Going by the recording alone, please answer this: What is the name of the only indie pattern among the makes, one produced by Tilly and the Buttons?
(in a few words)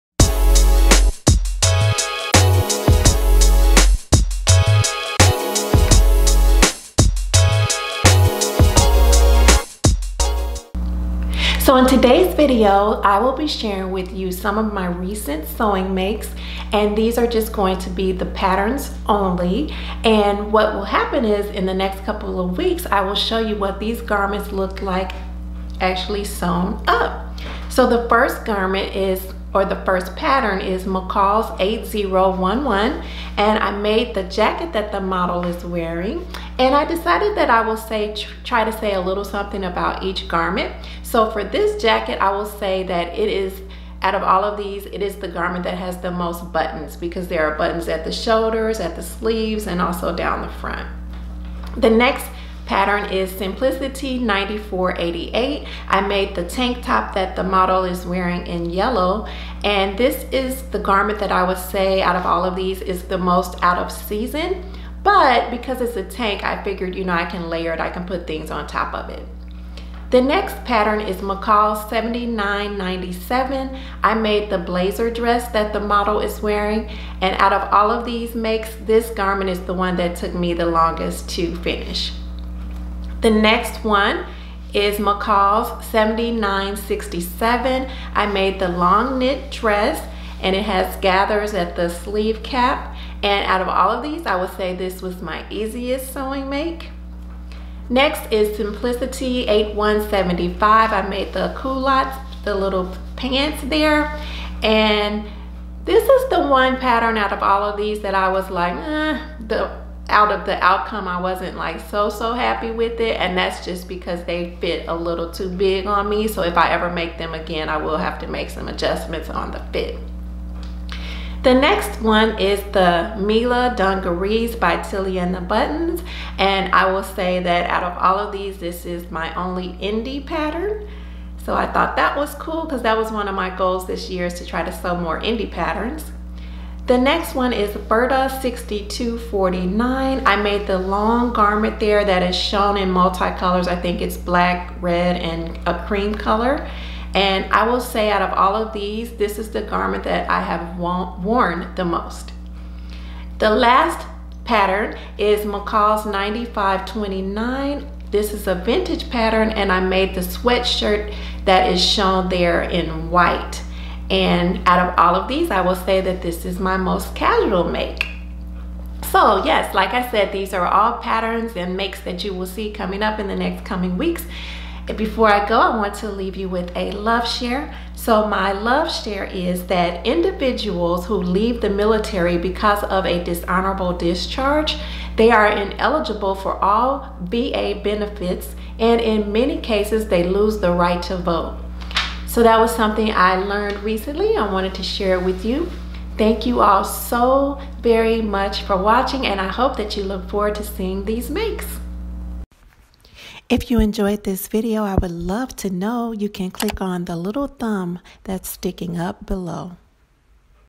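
Mila Dungarees.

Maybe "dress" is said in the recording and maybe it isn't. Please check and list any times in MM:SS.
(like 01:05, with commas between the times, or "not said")
01:15, 01:29.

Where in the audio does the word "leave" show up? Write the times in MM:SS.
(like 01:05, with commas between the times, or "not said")
02:56, 03:01.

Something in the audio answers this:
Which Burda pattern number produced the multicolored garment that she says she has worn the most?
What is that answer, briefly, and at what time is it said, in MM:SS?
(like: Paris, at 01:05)
6249, at 02:18.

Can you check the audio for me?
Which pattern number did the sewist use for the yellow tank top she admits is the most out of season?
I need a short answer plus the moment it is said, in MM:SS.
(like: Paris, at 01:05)
Simplicity 9488, at 00:53.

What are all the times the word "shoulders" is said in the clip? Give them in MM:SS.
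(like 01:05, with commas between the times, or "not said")
00:48.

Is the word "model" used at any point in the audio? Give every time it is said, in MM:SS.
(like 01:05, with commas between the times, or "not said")
00:34, 00:57, 01:15.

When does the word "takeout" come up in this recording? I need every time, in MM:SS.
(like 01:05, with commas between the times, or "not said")
not said.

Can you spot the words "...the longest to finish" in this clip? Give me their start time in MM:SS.
01:20.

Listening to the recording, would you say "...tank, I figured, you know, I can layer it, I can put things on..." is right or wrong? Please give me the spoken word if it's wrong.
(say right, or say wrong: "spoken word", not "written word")
right.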